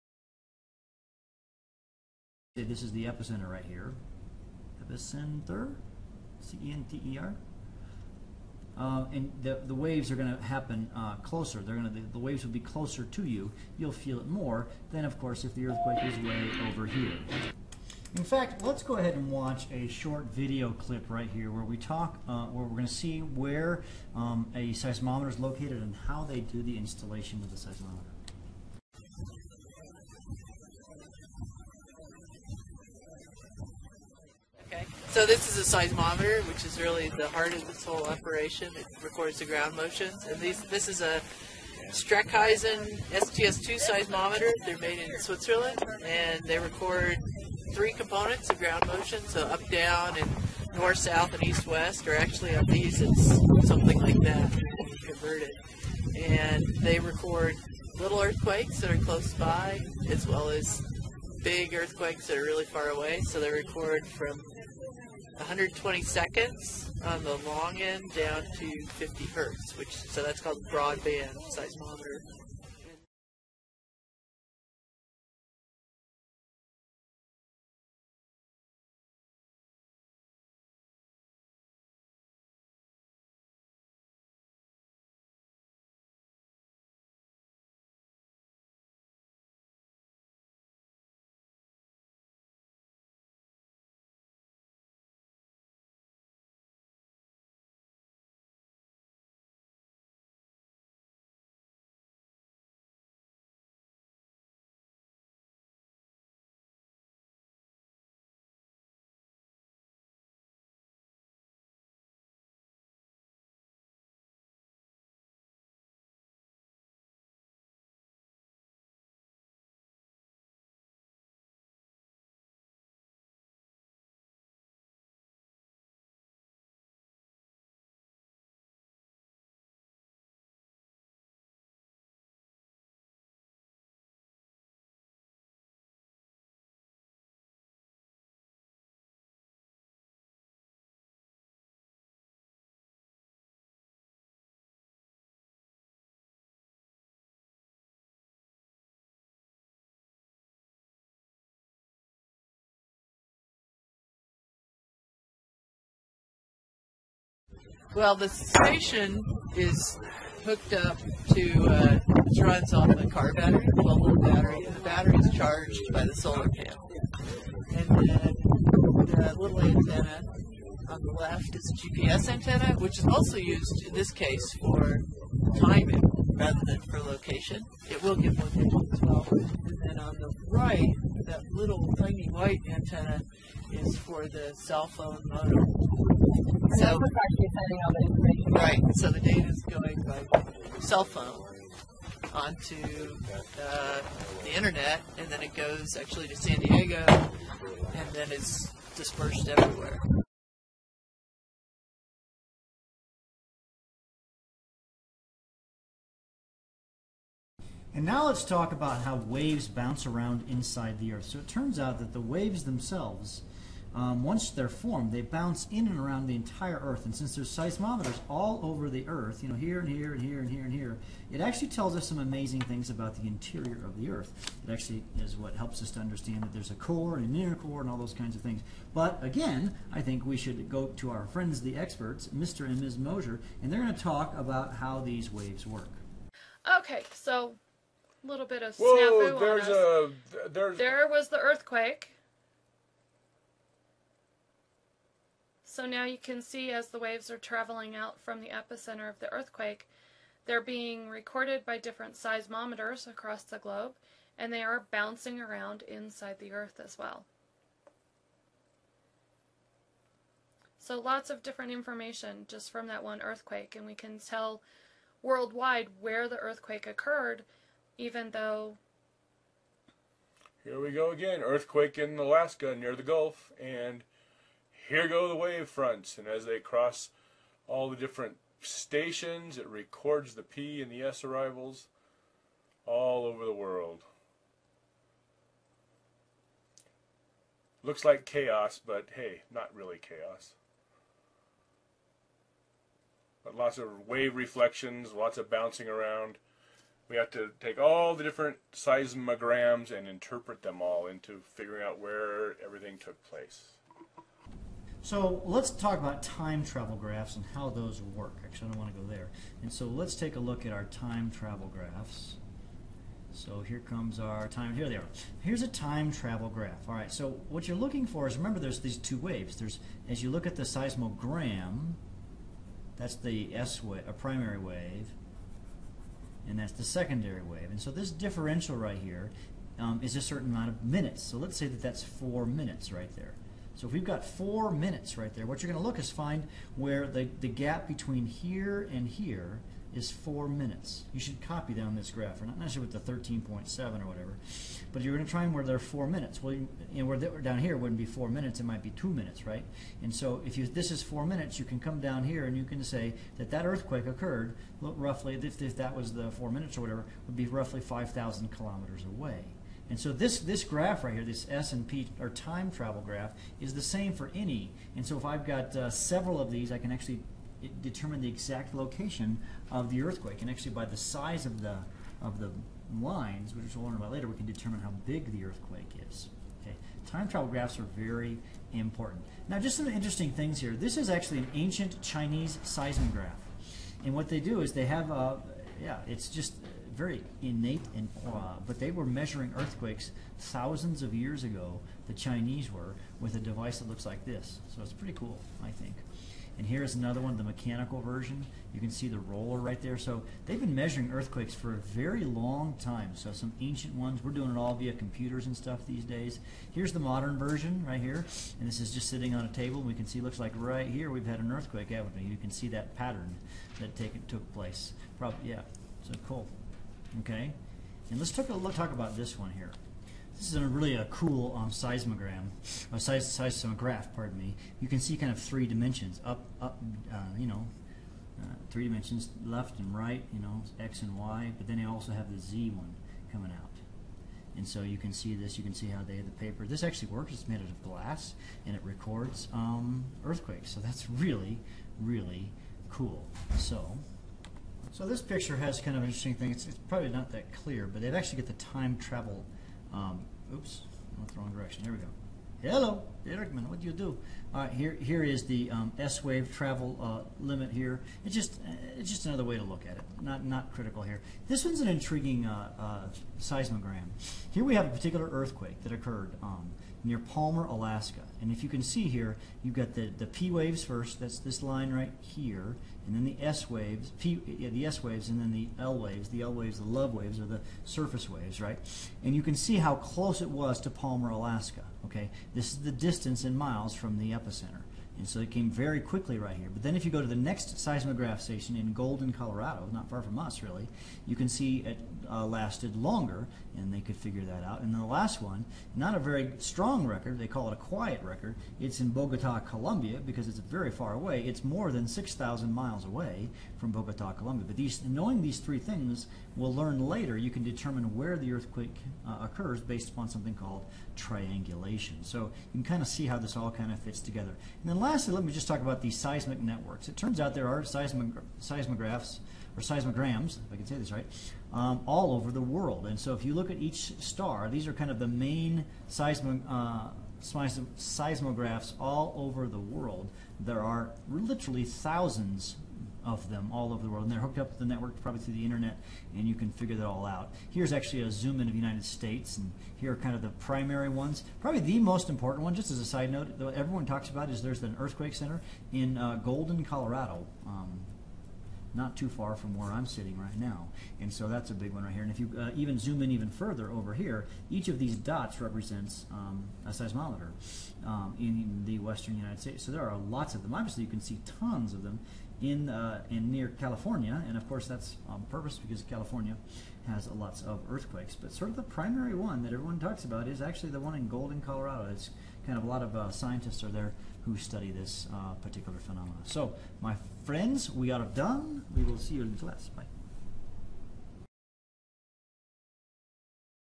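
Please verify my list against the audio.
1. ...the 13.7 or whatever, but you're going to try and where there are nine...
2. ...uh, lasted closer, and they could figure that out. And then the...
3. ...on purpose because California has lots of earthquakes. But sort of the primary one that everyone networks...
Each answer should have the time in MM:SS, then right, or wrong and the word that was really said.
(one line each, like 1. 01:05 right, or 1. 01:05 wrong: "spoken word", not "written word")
1. 05:43 wrong: "four", not "nine"
2. 08:12 wrong: "longer", not "closer"
3. 09:25 wrong: "talks", not "networks".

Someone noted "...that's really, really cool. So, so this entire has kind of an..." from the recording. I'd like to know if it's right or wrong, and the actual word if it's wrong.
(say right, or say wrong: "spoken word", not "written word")
wrong: "picture", not "entire".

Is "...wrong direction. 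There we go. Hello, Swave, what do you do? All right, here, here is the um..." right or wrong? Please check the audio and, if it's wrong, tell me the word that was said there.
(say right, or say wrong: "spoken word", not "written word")
wrong: "Erickman", not "Swave".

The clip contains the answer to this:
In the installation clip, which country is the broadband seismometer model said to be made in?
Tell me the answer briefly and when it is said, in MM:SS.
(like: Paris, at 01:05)
Switzerland, at 00:45.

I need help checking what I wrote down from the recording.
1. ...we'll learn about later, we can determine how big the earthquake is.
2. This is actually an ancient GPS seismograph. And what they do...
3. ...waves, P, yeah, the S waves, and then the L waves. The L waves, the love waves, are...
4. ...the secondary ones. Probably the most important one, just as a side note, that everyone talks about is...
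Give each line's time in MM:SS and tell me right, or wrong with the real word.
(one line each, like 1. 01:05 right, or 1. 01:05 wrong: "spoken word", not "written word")
1. 06:13 right
2. 06:20 wrong: "Chinese", not "GPS"
3. 07:53 right
4. 09:00 wrong: "primary", not "secondary".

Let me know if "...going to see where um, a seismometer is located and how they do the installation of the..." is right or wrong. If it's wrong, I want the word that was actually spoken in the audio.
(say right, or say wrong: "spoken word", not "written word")
right.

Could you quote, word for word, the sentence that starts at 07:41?
This one's an intriguing uh, uh, seismogram.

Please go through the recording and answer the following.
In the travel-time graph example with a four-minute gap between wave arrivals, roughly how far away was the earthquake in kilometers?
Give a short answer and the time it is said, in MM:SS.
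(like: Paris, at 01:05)
5,000, at 05:57.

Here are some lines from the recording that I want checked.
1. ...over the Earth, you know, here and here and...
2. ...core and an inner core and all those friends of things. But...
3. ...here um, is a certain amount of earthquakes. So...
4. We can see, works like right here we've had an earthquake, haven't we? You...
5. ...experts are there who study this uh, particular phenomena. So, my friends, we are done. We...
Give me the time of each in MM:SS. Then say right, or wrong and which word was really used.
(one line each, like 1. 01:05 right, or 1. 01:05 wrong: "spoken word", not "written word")
1. 03:38 right
2. 03:46 wrong: "kinds", not "friends"
3. 05:28 wrong: "minutes", not "earthquakes"
4. 06:49 wrong: "looks", not "works"
5. 09:33 wrong: "scientists", not "experts".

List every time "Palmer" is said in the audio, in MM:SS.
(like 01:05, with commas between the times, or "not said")
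07:47, 08:00.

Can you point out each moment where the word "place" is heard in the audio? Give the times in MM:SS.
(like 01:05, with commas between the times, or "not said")
05:03, 06:54.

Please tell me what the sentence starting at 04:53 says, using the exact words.
But lots of wave reflections, lots of bouncing around.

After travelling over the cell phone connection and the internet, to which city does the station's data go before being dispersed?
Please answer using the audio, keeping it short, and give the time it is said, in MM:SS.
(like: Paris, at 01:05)
San Diego, at 03:16.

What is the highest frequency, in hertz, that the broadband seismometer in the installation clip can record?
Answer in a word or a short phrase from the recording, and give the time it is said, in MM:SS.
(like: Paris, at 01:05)
50, at 01:08.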